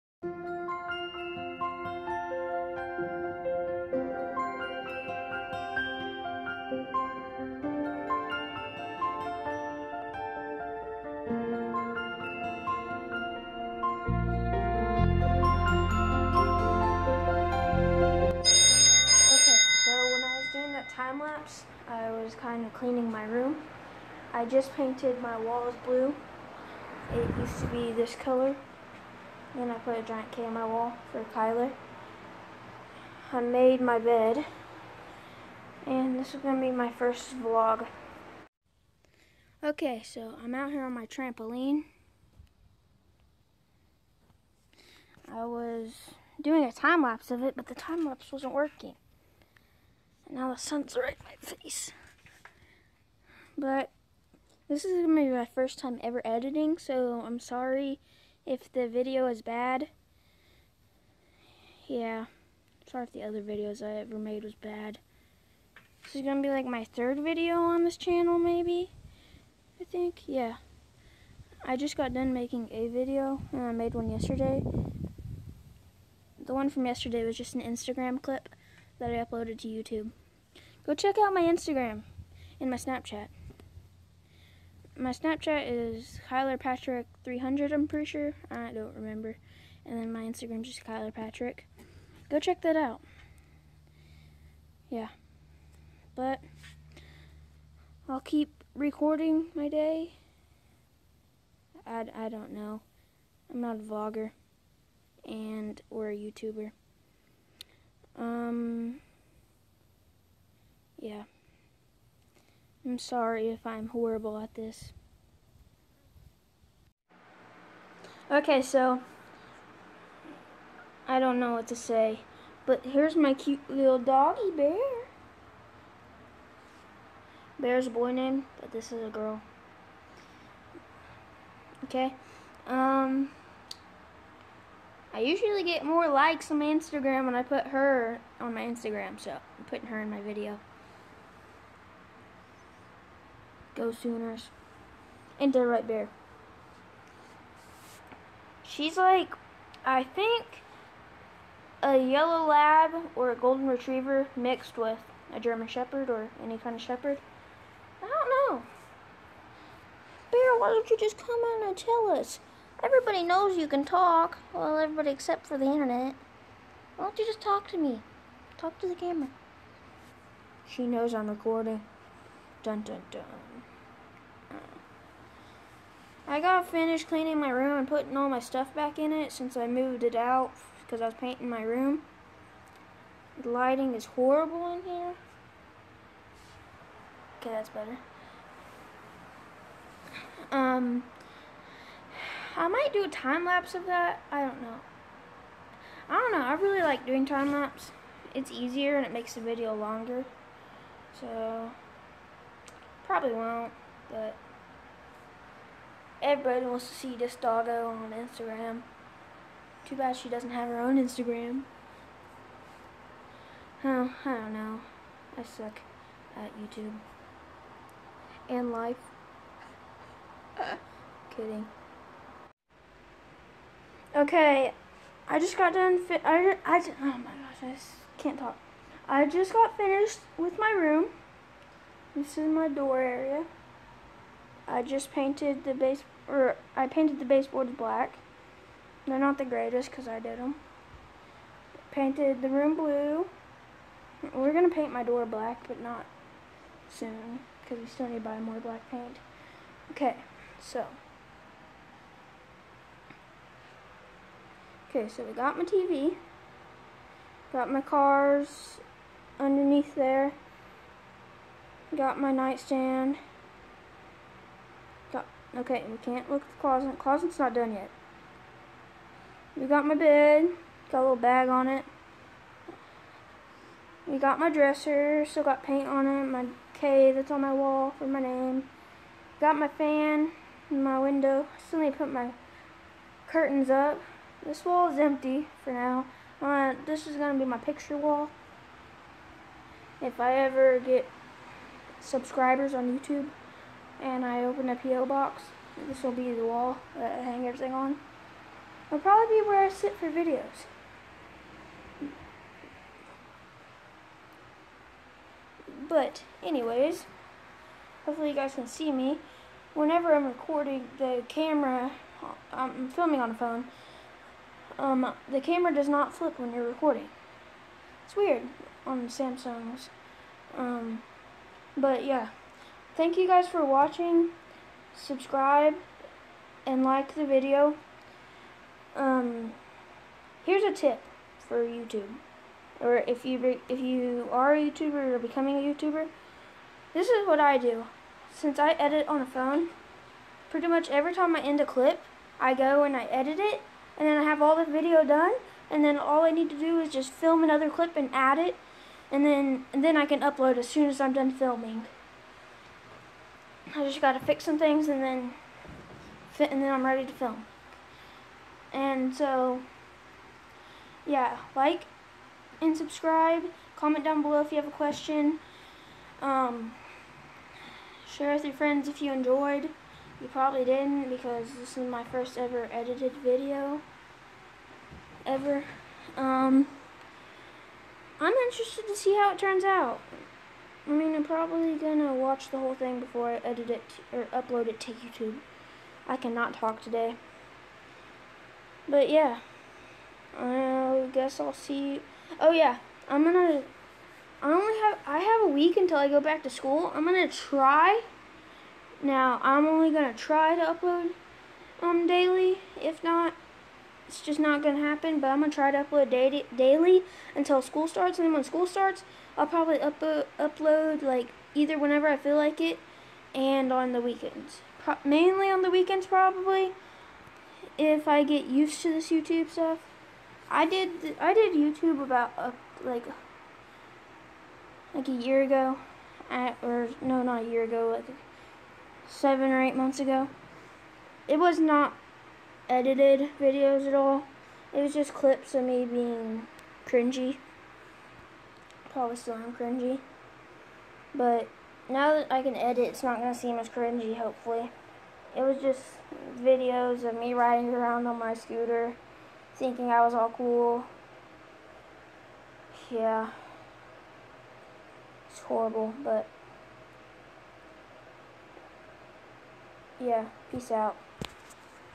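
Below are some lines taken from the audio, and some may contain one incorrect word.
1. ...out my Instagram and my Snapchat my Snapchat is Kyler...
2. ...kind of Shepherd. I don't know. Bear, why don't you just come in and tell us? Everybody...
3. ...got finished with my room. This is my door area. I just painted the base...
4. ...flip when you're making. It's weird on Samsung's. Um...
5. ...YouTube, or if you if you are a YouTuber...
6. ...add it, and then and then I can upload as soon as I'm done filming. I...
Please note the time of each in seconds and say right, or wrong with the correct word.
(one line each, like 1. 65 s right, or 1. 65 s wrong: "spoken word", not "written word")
1. 81 s right
2. 156 s right
3. 229 s right
4. 316 s wrong: "recording", not "making"
5. 331 s right
6. 348 s right.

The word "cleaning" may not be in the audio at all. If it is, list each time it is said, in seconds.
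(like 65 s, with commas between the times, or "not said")
22 s, 177 s.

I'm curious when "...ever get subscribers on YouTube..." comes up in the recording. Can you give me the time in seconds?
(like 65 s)
290 s.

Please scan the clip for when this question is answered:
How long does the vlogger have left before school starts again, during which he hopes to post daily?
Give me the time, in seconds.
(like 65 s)
395 s.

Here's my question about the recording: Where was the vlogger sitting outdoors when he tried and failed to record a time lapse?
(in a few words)
Trampoline.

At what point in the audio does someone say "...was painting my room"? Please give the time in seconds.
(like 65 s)
181 s.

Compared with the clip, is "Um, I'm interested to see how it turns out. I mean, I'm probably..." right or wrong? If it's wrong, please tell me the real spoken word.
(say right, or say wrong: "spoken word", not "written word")
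right.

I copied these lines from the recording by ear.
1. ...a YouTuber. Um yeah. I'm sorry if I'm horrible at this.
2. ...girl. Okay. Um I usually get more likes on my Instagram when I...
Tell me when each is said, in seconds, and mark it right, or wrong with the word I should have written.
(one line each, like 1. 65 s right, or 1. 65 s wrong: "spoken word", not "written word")
1. 106 s right
2. 129 s right.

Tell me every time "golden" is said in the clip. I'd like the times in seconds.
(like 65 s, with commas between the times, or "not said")
153 s.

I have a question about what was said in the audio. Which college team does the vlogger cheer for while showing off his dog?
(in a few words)
Sooners.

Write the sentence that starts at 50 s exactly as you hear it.
And now the sun's right in my face.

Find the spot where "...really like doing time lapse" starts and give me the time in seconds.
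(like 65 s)
196 s.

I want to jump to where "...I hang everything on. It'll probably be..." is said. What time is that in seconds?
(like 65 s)
297 s.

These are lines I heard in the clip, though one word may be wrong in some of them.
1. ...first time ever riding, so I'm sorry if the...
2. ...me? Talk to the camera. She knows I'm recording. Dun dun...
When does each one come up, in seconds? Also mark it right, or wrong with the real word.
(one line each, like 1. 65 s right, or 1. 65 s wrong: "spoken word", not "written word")
1. 55 s wrong: "editing", not "riding"
2. 167 s right.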